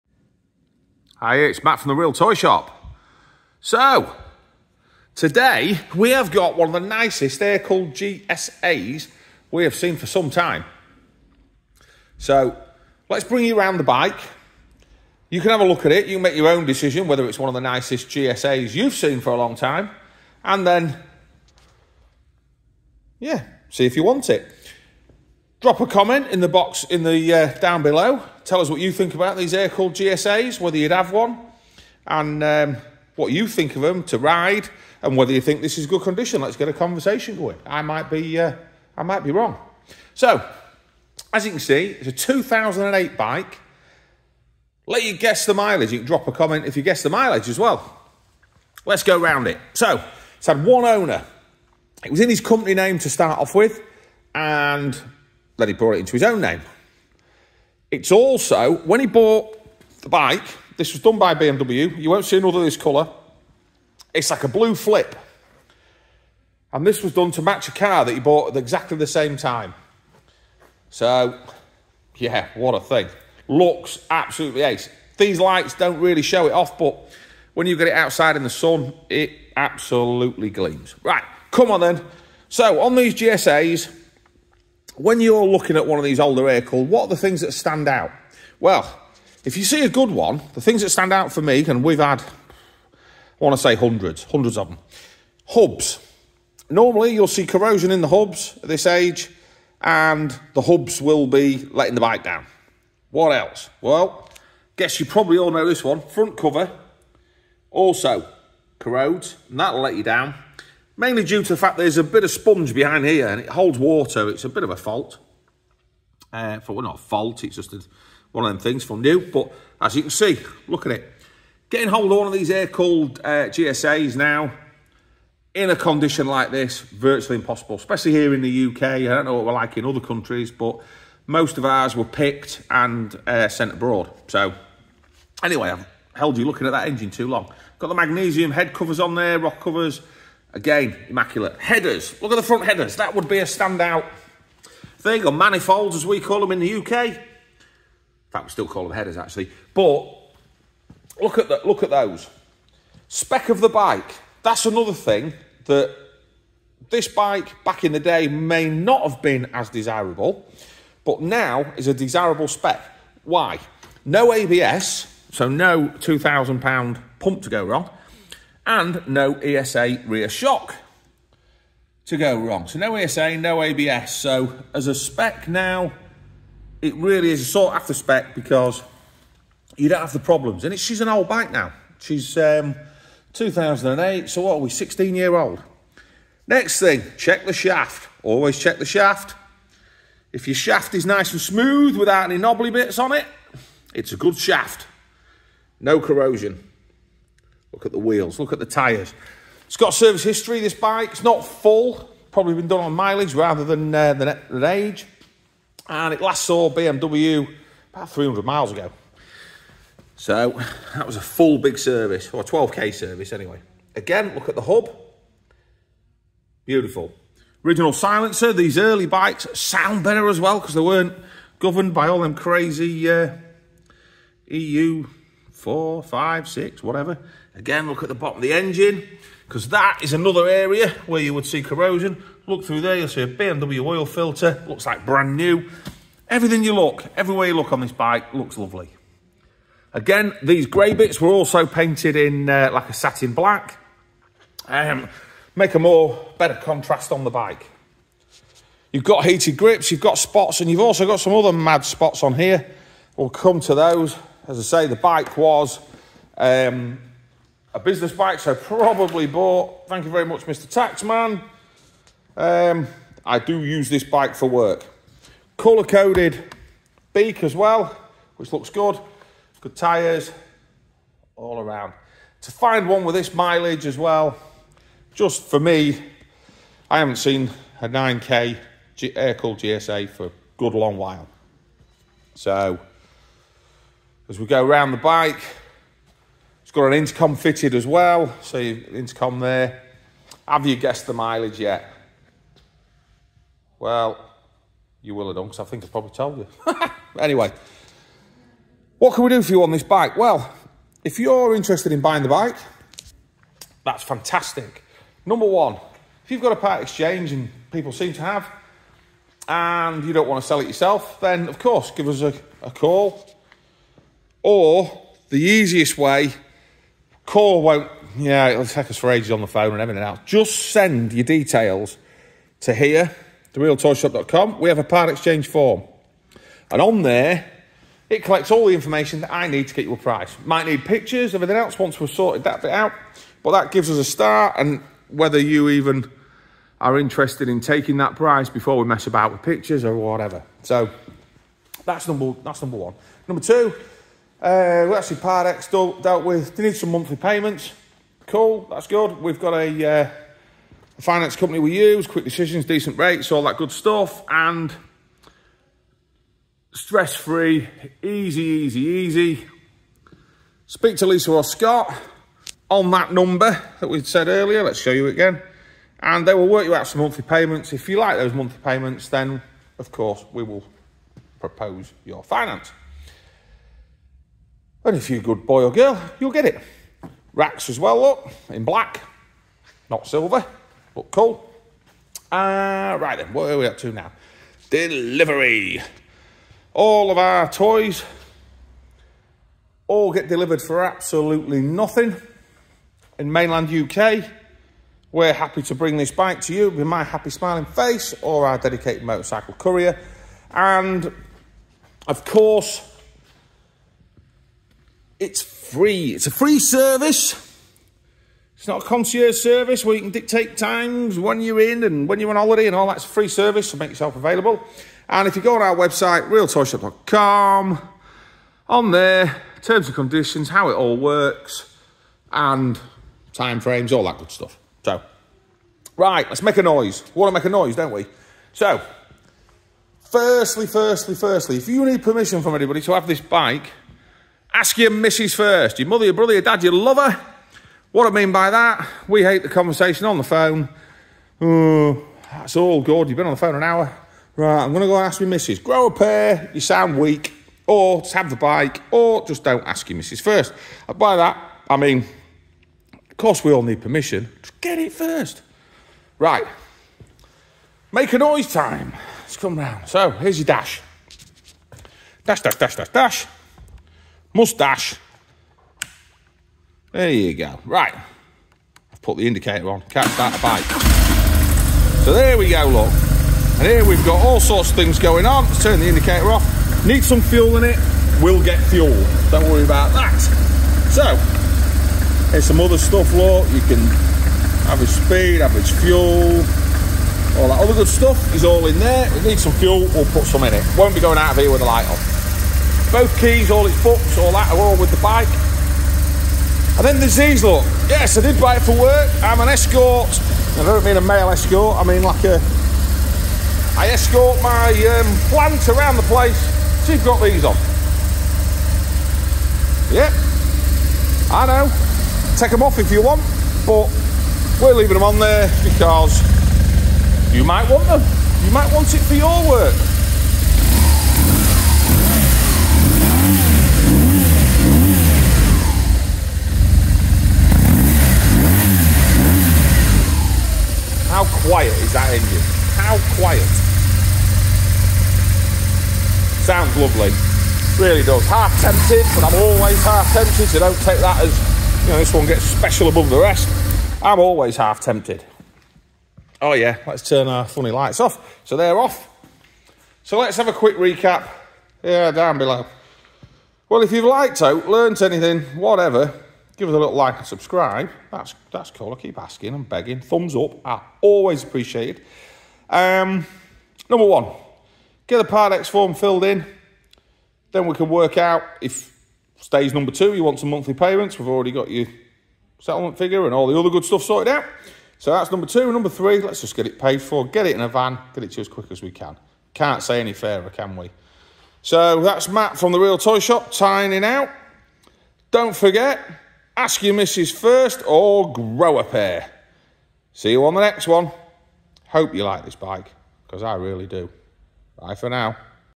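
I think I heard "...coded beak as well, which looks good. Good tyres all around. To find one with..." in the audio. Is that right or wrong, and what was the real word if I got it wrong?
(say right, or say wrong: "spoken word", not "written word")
right.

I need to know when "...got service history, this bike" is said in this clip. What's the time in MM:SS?
03:19.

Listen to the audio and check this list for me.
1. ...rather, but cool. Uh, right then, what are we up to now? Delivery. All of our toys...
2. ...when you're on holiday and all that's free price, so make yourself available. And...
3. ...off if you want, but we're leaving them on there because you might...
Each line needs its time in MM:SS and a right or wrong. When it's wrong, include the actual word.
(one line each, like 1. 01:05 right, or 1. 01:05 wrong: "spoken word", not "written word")
1. 06:20 wrong: "silver", not "rather"
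2. 06:52 wrong: "service", not "price"
3. 08:32 right.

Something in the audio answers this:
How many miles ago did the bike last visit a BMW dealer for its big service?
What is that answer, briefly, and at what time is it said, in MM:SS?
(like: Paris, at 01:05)
300, at 03:28.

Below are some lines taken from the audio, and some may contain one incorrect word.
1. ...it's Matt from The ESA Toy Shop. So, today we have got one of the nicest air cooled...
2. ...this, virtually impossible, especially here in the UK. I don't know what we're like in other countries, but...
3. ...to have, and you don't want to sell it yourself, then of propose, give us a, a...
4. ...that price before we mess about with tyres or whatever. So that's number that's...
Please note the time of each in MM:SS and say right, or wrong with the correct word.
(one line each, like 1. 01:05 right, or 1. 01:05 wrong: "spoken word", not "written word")
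1. 00:01 wrong: "Real", not "ESA"
2. 02:06 right
3. 05:08 wrong: "course", not "propose"
4. 05:37 wrong: "pictures", not "tyres".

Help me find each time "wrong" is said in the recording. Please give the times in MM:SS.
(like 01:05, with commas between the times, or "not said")
00:39, 02:47, 02:52.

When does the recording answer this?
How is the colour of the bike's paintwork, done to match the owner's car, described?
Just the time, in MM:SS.
01:04.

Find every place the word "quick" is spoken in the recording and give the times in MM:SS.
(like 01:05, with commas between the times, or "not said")
05:52, 09:10, 09:38.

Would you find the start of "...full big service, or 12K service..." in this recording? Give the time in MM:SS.
03:31.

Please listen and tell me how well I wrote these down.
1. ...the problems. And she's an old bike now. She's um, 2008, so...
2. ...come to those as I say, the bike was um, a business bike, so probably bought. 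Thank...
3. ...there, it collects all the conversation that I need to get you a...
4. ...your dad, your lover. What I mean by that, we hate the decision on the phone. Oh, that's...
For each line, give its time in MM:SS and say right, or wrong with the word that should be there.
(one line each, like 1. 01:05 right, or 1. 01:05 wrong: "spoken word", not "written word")
1. 03:00 right
2. 04:13 right
3. 05:27 wrong: "information", not "conversation"
4. 07:16 wrong: "conversation", not "decision".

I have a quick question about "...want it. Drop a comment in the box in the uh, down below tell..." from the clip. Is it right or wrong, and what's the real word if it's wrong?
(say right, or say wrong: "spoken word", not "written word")
right.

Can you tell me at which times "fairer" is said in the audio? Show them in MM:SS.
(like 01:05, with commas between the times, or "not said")
09:40.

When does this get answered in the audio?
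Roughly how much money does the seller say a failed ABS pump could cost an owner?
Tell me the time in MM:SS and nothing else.
02:45.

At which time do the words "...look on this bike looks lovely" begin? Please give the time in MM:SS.
03:57.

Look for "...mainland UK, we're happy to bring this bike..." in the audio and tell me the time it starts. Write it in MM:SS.
06:33.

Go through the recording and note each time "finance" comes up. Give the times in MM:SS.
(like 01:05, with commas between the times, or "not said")
05:51, 06:12.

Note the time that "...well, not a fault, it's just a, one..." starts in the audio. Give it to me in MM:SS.
01:56.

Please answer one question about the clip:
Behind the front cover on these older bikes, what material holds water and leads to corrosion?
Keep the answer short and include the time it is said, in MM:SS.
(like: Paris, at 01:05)
sponge, at 01:52.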